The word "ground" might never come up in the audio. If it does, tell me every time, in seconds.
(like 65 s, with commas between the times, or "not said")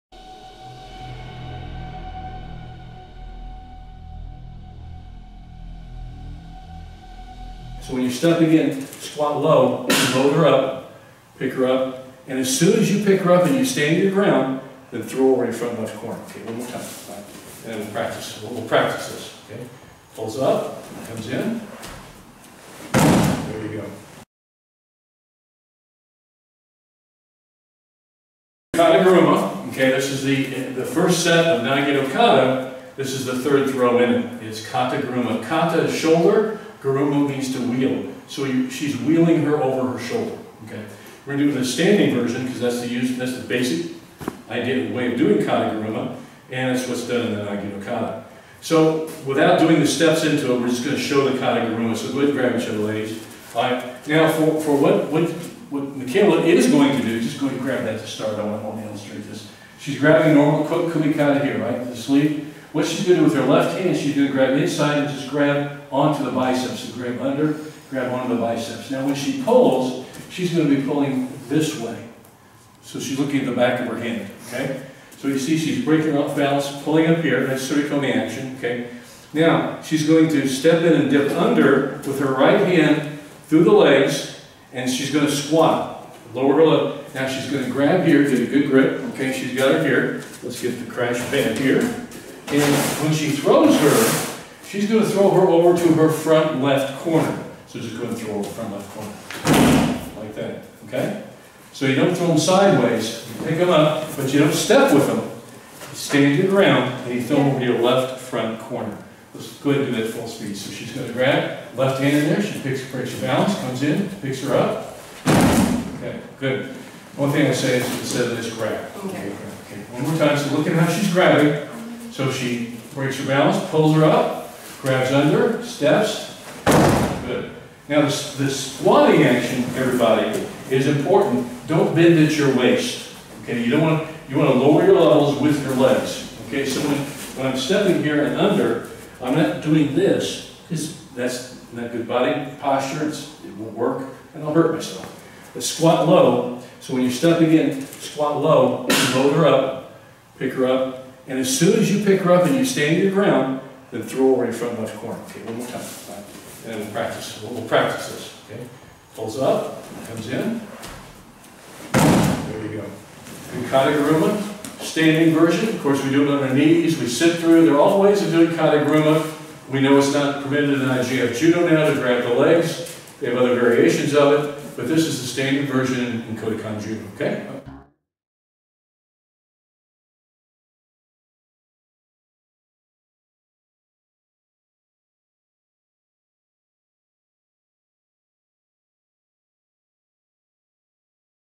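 14 s, 106 s, 153 s.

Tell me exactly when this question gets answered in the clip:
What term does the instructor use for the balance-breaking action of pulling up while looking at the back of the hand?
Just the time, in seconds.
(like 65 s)
77 s.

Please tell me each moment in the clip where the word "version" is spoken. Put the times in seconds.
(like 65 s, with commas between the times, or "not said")
42 s, 165 s, 175 s.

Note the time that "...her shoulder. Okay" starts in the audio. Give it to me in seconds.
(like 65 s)
39 s.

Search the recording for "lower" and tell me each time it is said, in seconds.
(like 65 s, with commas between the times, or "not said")
86 s, 134 s.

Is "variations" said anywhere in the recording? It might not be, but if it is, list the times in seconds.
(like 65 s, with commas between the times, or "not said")
173 s.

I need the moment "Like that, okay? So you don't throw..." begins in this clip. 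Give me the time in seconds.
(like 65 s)
100 s.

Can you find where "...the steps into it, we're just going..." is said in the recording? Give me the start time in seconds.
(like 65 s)
49 s.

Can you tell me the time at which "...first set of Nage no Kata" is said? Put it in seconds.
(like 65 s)
30 s.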